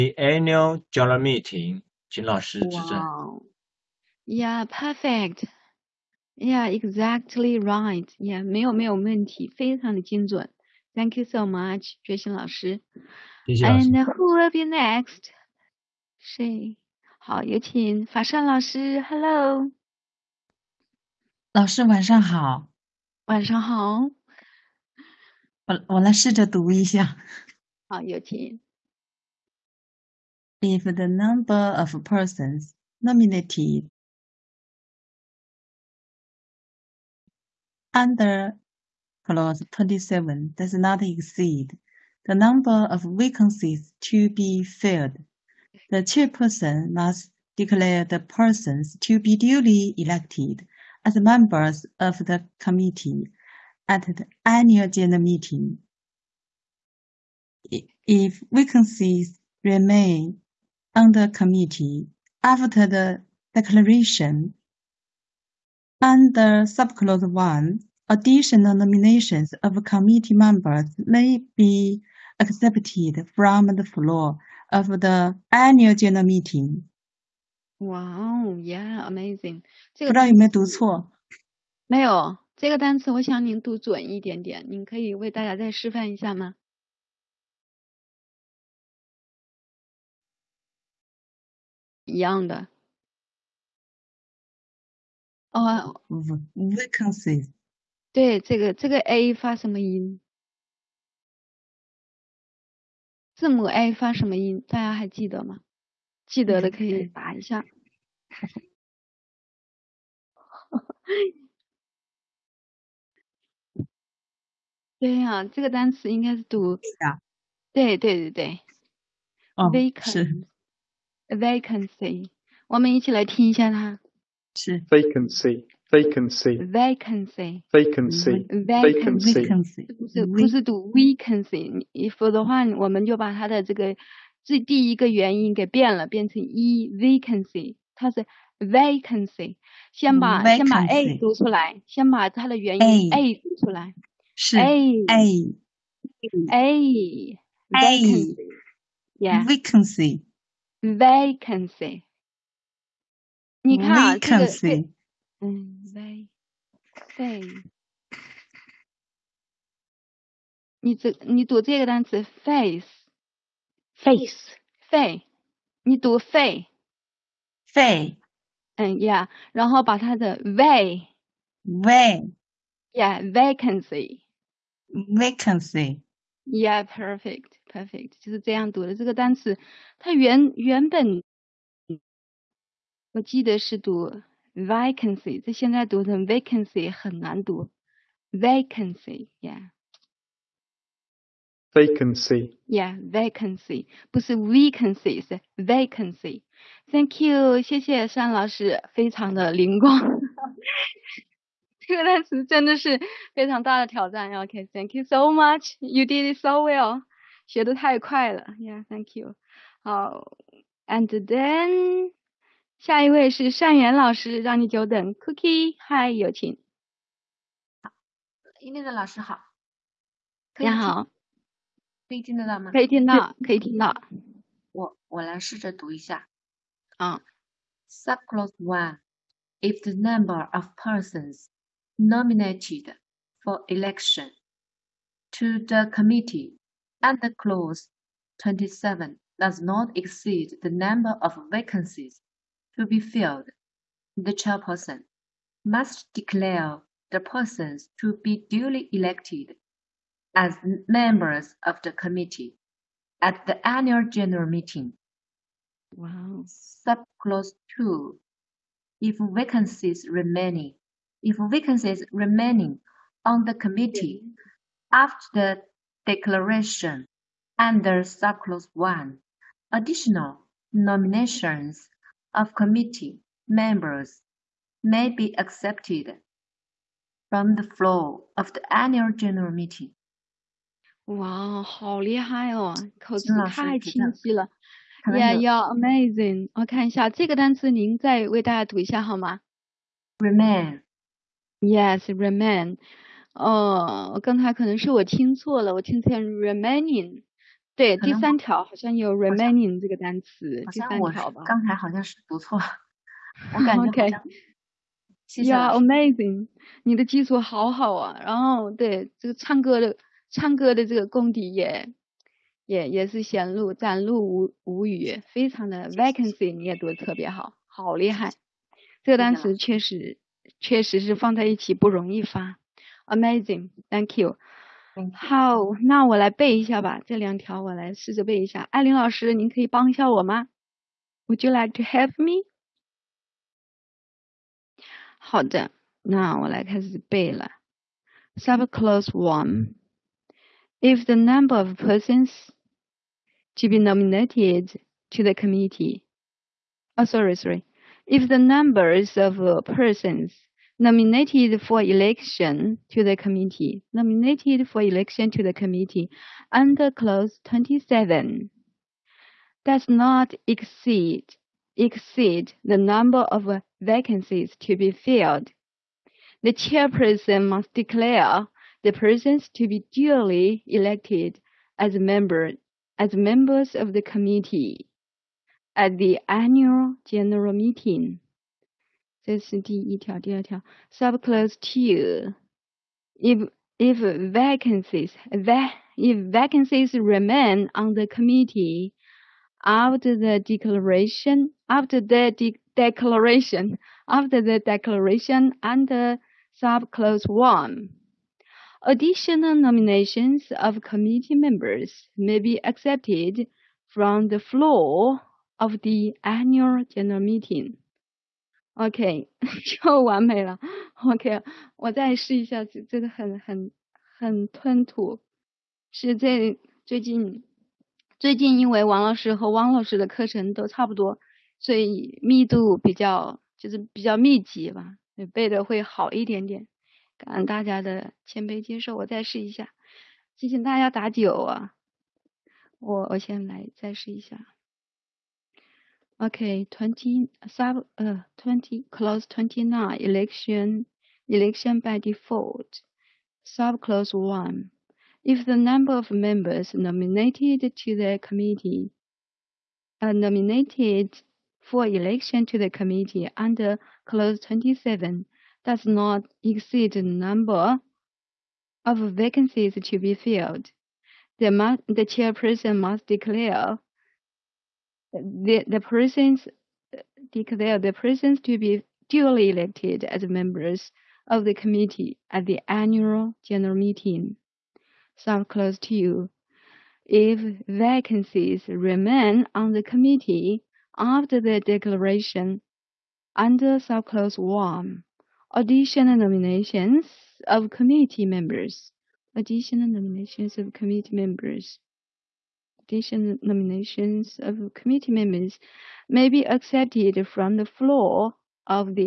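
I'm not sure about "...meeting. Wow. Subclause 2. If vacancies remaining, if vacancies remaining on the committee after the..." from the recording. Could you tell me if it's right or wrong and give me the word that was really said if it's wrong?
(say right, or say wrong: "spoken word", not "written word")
right.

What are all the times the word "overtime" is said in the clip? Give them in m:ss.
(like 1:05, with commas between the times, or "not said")
not said.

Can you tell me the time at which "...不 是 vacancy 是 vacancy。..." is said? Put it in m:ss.
3:14.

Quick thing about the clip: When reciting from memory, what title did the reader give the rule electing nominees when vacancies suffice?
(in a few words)
election by default.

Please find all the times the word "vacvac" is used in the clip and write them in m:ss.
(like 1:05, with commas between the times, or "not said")
2:35.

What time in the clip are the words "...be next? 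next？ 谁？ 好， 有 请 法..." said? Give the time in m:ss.
0:14.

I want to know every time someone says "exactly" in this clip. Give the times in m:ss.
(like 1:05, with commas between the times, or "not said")
0:06.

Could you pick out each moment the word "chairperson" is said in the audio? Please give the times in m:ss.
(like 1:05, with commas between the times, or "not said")
0:46, 4:04, 6:06, 7:42.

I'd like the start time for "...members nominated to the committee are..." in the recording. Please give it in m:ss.
7:26.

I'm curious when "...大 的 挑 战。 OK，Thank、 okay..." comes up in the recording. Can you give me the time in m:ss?
3:23.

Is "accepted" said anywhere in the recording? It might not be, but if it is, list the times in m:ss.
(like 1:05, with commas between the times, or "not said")
1:12, 4:35, 6:42, 8:16.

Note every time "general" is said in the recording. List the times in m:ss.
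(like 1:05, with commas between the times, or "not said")
0:00, 0:54, 1:15, 4:14, 4:39, 6:17, 6:46, 7:53.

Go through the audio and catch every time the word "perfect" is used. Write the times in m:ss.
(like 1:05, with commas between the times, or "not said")
0:04.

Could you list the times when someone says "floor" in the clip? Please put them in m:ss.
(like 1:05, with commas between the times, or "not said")
1:13, 4:37, 6:44, 8:17.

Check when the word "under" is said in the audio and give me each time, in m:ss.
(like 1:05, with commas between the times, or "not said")
0:37, 1:06, 3:57, 4:27, 5:56, 6:35, 7:33, 8:03.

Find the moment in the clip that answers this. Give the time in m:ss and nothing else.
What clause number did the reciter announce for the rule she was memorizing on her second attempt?
7:18.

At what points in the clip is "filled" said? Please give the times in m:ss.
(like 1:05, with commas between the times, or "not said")
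0:44, 4:02, 6:04, 7:40.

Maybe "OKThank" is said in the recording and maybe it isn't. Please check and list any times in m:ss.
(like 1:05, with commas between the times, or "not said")
3:24.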